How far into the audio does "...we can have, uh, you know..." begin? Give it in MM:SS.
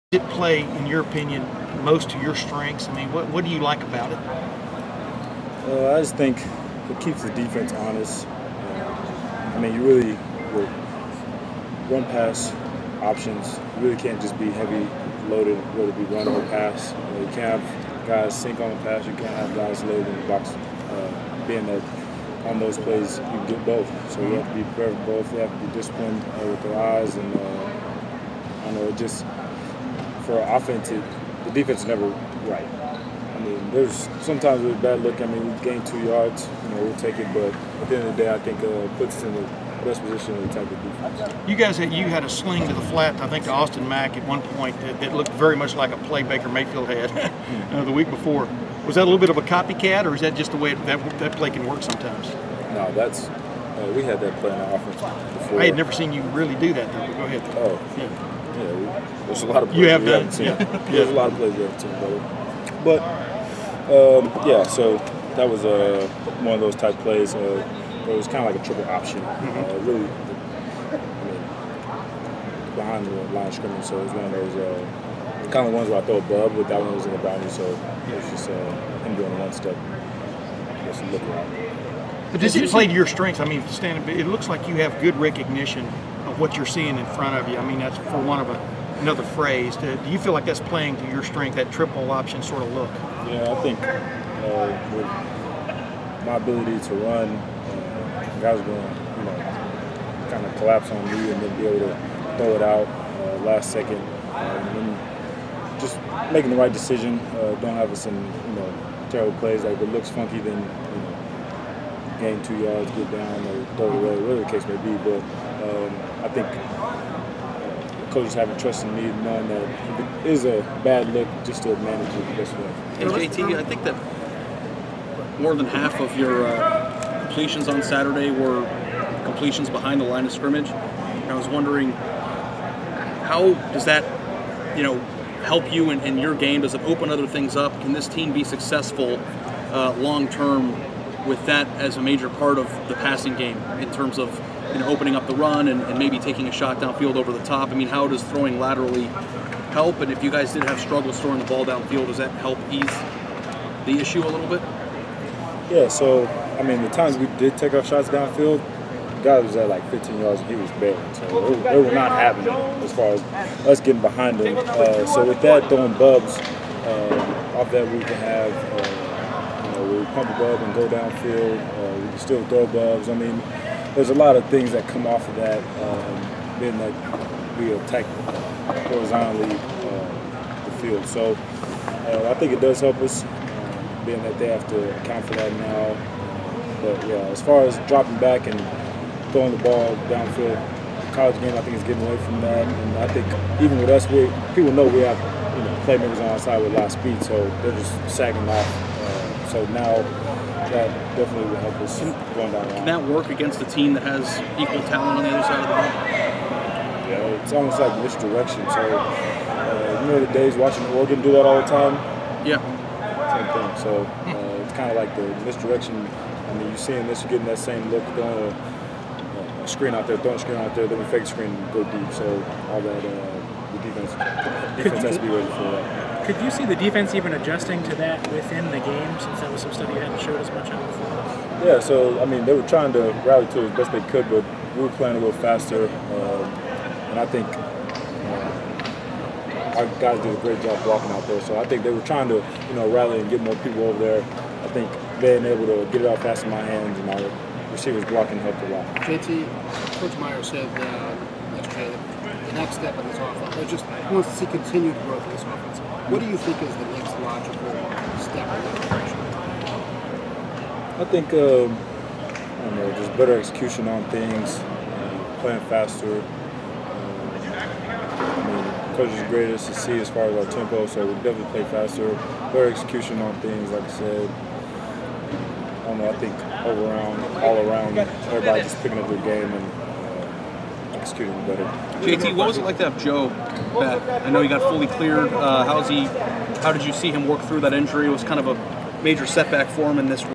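02:47.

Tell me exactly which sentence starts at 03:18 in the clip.
Uh, so now that definitely would help us going down.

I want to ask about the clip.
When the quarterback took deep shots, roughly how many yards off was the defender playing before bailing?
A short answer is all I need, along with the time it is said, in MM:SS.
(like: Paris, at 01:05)
15 yards, at 02:39.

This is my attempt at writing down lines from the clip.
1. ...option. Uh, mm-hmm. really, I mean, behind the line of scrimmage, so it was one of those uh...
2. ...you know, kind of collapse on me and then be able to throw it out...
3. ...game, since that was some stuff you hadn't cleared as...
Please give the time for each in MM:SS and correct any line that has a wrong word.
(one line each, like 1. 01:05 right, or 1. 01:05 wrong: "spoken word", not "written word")
1. 01:08 right
2. 01:39 right
3. 03:48 wrong: "showed", not "cleared".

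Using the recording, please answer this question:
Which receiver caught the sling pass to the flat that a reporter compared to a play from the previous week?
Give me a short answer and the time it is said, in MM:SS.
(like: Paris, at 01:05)
Austin Mack, at 00:43.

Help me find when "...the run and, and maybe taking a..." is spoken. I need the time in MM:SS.
02:25.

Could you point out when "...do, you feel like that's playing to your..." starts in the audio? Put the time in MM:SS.
01:29.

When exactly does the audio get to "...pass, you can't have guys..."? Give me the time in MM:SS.
00:18.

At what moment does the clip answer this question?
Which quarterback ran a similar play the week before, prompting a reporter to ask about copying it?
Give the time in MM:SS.
00:46.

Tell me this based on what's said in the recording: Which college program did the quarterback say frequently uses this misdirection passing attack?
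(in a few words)
Oregon.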